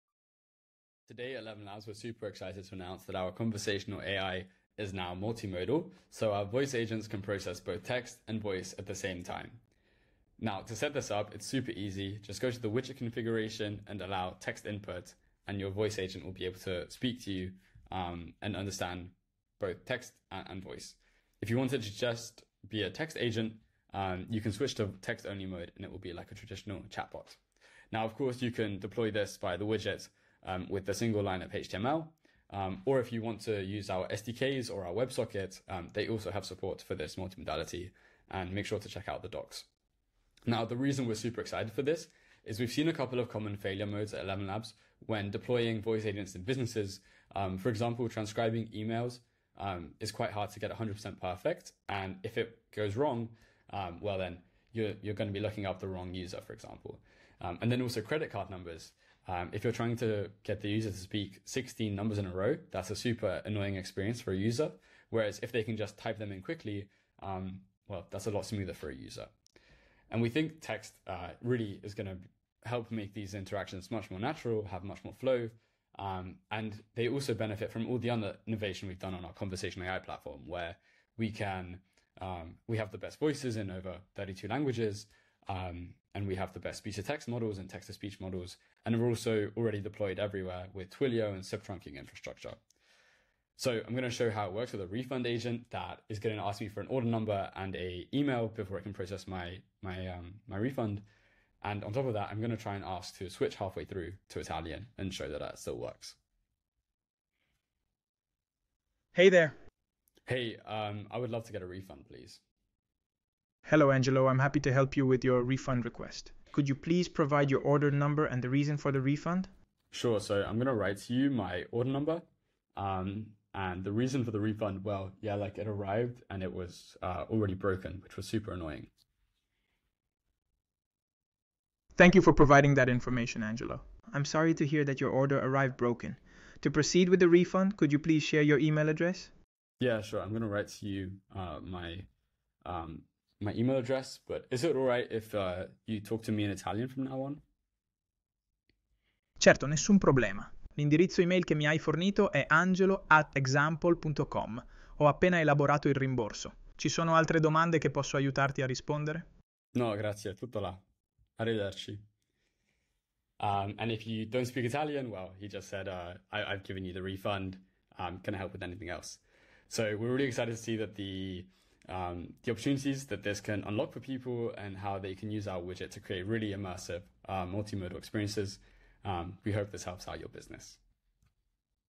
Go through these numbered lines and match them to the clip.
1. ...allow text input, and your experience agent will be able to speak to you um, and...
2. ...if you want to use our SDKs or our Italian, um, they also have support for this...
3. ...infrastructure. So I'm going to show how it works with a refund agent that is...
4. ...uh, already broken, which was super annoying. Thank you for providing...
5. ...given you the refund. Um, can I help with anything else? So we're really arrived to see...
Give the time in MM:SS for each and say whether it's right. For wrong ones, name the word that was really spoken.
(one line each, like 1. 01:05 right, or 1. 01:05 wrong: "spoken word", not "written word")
1. 00:14 wrong: "voice", not "experience"
2. 00:32 wrong: "WebSocket", not "Italian"
3. 01:31 right
4. 02:07 right
5. 02:46 wrong: "excited", not "arrived".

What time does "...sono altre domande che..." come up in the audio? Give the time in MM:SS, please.
02:36.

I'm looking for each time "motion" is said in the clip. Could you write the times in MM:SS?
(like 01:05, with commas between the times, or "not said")
not said.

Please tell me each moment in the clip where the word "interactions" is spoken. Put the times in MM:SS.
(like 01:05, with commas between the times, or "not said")
01:13.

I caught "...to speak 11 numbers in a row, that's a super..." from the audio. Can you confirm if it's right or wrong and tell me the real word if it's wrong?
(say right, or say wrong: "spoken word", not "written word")
wrong: "16", not "11".